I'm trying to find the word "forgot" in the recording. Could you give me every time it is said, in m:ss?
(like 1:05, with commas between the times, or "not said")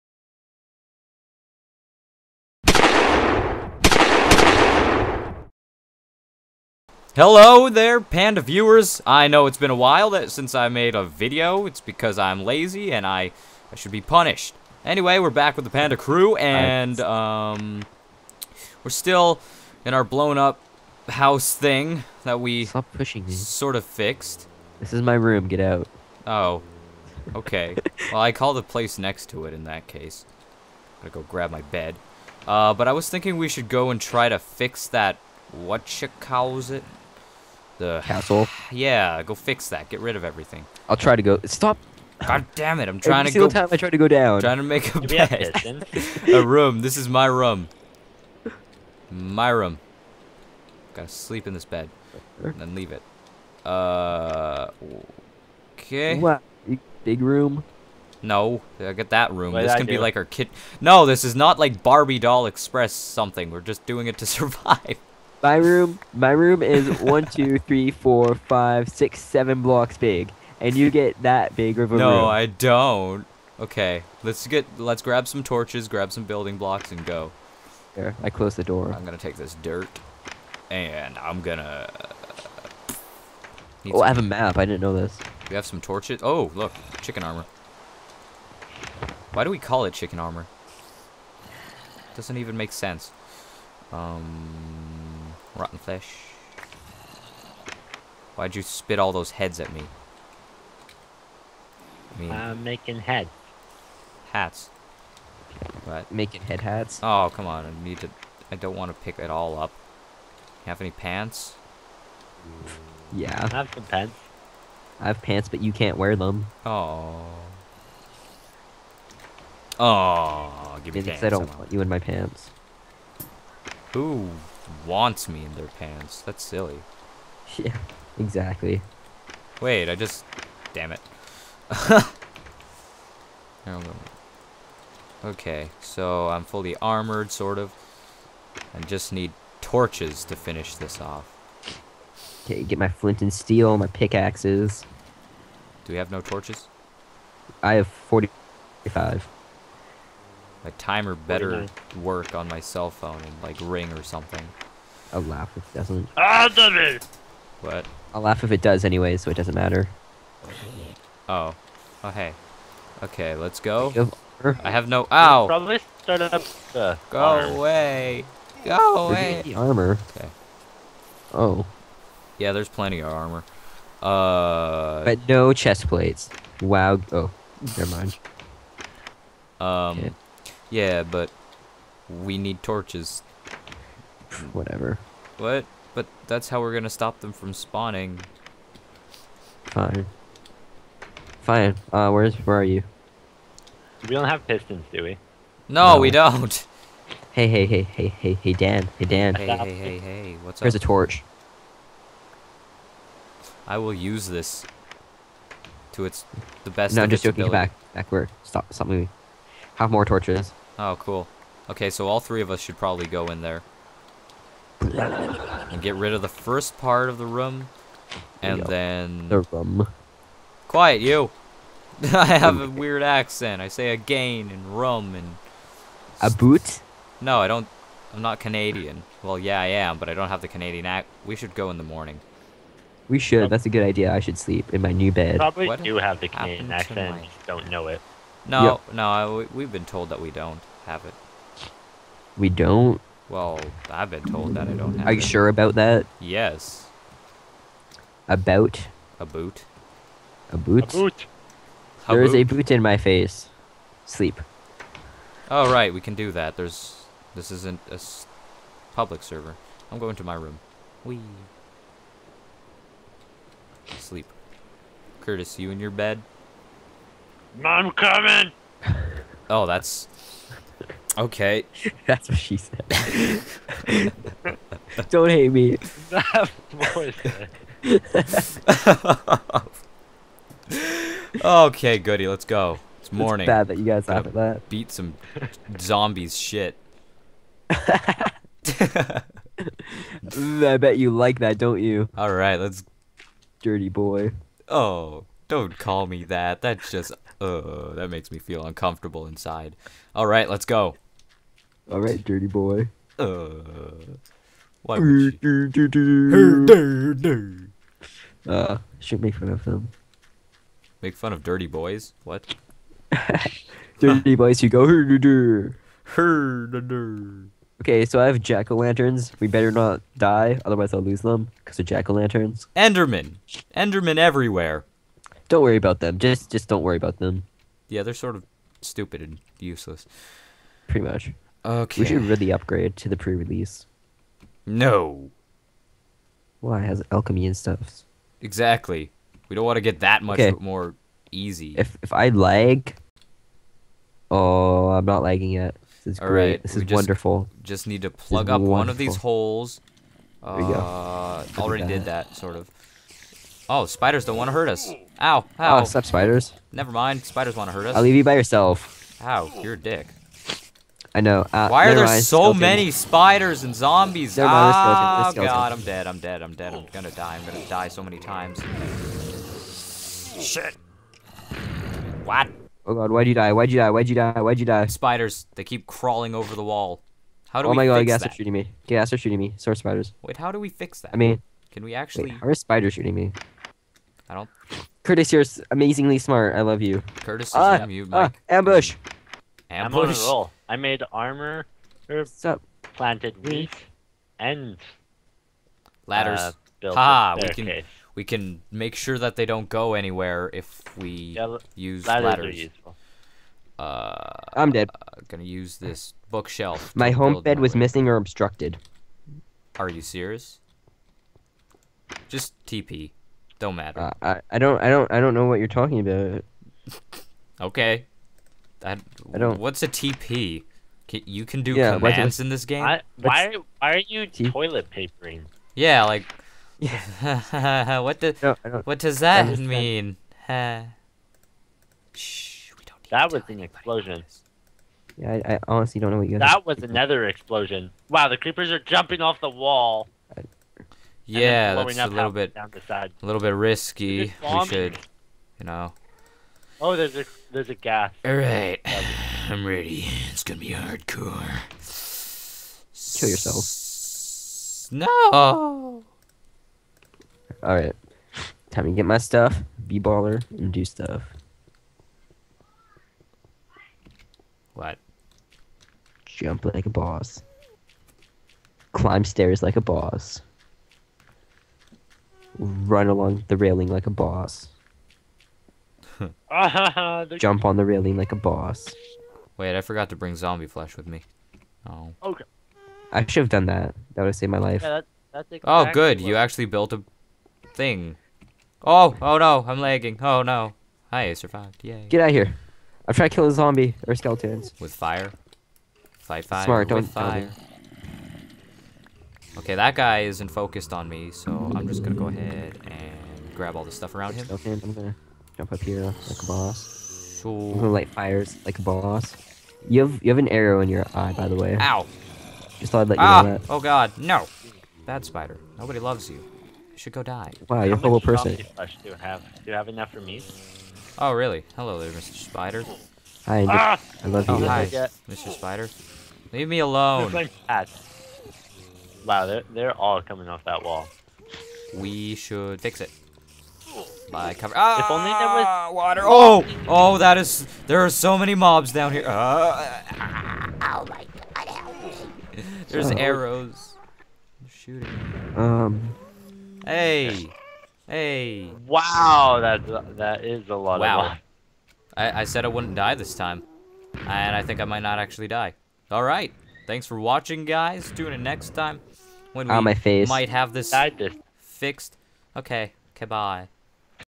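7:59.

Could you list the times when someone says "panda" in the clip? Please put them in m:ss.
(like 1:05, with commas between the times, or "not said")
0:07, 0:15.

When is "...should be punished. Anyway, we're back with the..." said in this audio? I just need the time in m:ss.
0:13.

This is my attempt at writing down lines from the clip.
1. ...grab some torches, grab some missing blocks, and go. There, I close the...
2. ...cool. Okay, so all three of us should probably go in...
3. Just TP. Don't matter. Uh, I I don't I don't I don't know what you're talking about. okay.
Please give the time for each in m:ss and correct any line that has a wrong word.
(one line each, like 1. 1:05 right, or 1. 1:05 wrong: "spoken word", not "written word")
1. 1:15 wrong: "building", not "missing"
2. 3:30 right
3. 6:52 right.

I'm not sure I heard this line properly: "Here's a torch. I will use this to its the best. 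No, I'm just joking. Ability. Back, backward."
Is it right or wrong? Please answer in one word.
right.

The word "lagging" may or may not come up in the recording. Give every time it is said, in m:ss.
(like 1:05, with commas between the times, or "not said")
5:45, 8:09.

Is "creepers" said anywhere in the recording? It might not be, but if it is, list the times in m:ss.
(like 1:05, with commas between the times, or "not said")
7:18.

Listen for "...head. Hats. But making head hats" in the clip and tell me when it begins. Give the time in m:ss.
1:43.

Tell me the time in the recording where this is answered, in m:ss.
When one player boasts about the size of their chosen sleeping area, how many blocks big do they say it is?
1:09.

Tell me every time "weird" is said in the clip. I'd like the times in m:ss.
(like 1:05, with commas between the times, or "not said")
3:42.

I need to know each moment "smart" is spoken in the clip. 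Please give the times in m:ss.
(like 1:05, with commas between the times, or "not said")
6:26, 8:16.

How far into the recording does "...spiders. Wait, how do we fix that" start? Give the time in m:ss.
6:19.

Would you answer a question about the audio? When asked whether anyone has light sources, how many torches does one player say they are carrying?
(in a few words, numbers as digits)
45.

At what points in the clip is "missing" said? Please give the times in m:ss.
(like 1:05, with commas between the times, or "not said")
6:47.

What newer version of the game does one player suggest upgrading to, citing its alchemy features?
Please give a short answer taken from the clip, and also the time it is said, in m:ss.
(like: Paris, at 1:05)
the pre-release, at 5:33.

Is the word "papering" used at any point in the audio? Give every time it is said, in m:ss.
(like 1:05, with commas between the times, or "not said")
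7:04.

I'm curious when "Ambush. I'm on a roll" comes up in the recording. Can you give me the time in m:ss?
6:29.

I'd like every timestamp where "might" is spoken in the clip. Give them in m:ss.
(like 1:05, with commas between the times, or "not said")
9:14, 9:20.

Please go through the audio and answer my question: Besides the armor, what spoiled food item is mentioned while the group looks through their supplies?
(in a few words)
Rotten fish.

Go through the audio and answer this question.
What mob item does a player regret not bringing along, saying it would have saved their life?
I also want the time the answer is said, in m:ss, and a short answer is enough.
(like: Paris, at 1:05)
zombie flesh, at 8:00.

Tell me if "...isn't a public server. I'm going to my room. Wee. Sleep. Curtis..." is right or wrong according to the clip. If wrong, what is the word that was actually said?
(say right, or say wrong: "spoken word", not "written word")
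right.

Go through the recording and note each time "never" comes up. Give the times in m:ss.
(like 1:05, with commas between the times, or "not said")
2:57, 5:56, 6:04.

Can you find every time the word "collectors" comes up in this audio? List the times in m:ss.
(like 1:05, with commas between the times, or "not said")
not said.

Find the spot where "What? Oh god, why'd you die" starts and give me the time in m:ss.
6:12.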